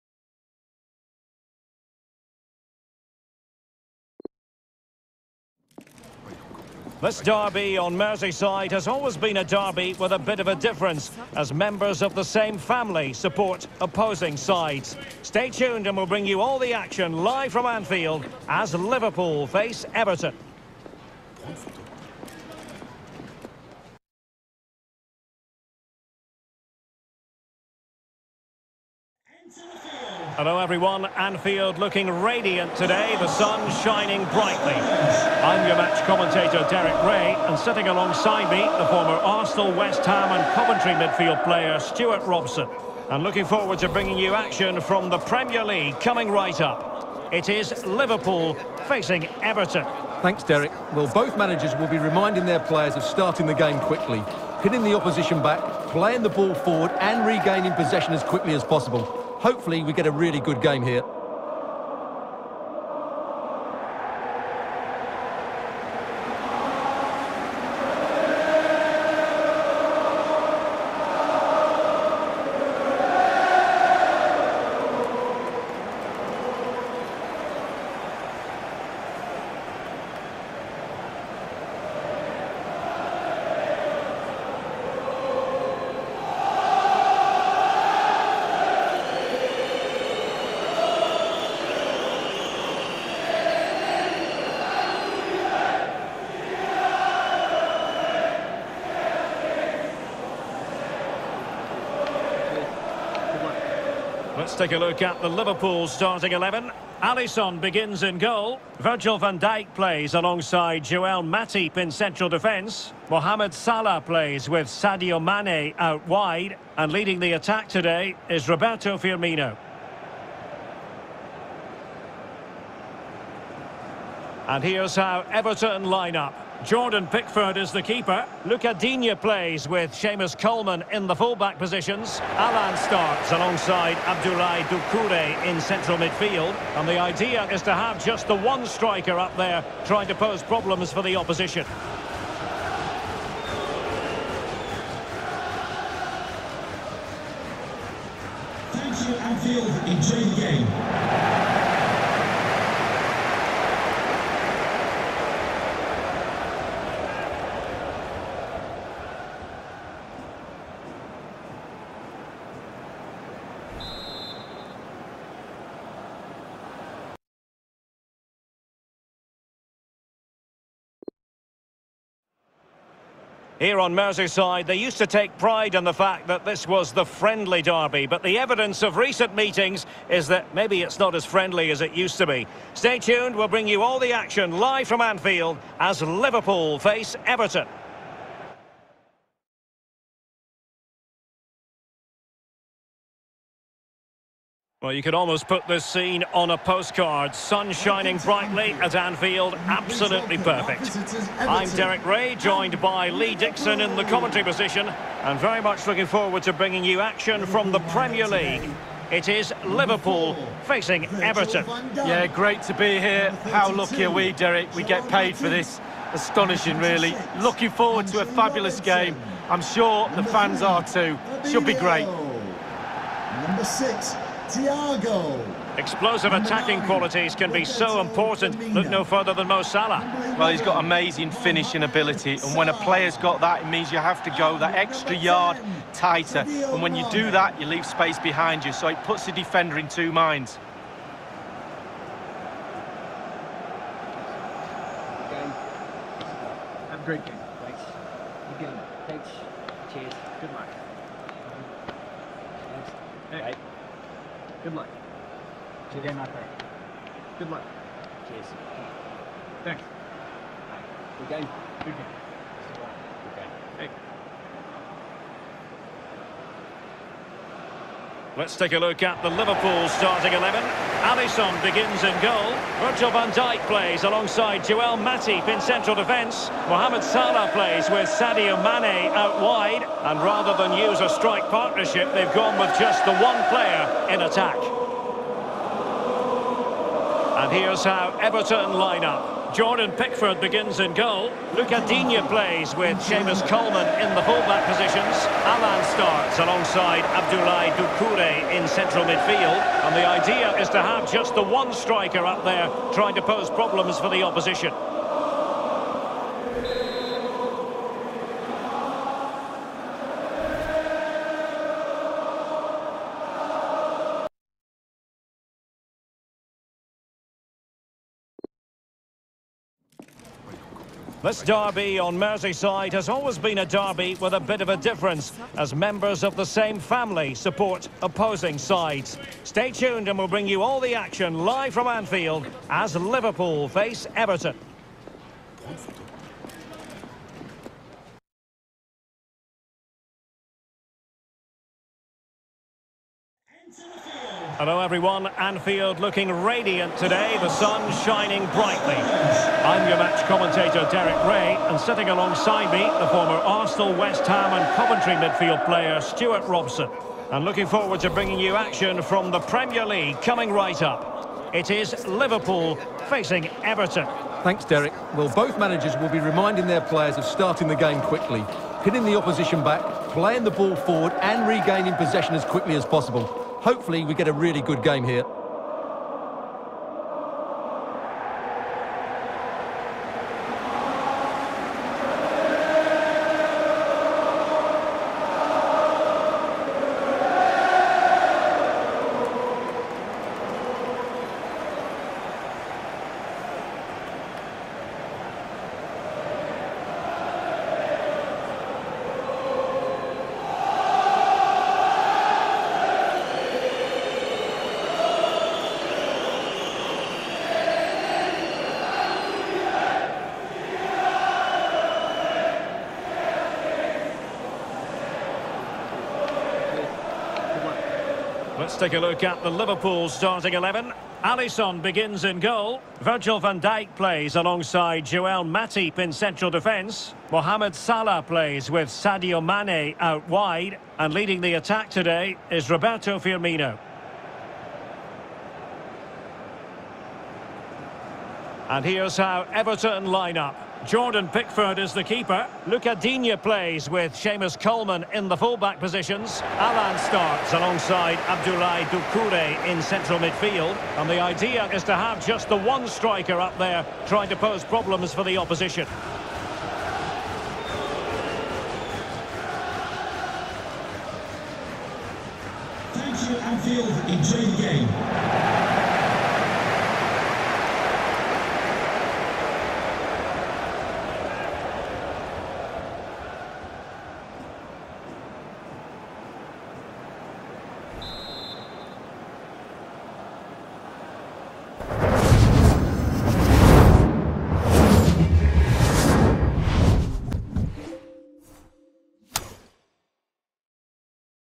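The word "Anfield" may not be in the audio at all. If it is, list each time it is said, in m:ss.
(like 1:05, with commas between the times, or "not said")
0:17, 0:31, 2:29, 3:04, 3:18, 5:31, 5:45, 7:43.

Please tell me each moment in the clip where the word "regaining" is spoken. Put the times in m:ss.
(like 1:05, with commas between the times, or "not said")
0:57, 6:11.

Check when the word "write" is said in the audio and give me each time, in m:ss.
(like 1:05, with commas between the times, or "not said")
not said.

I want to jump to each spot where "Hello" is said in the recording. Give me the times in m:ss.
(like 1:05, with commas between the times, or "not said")
0:30, 5:44.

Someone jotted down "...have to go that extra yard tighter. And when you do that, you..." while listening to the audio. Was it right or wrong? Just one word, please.
right.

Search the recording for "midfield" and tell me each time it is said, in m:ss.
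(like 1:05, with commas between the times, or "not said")
0:40, 2:15, 4:59, 5:55, 7:30.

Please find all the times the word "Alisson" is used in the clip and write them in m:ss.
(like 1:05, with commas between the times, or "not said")
1:47, 4:31, 7:01.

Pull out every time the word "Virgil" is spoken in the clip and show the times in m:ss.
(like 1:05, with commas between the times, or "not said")
1:48, 4:32, 7:02.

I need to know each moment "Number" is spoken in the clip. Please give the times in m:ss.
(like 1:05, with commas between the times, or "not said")
3:43.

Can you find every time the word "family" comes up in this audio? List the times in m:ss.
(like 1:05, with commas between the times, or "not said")
0:12, 5:26.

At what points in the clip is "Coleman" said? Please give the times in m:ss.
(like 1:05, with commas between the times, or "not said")
2:10, 4:53, 7:24.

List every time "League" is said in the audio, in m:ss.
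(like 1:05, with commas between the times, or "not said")
0:45, 3:28, 5:59.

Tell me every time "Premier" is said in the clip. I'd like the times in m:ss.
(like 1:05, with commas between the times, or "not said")
0:45, 3:27, 5:59.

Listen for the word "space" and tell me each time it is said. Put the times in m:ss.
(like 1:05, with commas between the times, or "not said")
3:57.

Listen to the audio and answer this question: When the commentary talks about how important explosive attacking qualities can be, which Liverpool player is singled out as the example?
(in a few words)
Mo Salah.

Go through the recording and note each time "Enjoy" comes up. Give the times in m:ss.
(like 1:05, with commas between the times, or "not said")
2:29, 7:44.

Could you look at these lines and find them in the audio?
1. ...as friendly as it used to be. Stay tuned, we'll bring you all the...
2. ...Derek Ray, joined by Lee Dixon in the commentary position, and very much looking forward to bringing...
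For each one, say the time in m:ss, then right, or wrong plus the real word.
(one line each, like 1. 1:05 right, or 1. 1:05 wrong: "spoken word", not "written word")
1. 3:01 right
2. 3:21 right.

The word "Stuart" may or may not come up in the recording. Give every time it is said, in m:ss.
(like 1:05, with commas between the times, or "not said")
0:41, 5:56.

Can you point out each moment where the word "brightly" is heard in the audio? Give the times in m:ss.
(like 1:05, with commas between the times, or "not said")
0:34, 3:18, 5:48.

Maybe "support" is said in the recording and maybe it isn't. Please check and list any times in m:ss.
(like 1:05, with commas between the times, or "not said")
0:13, 5:27.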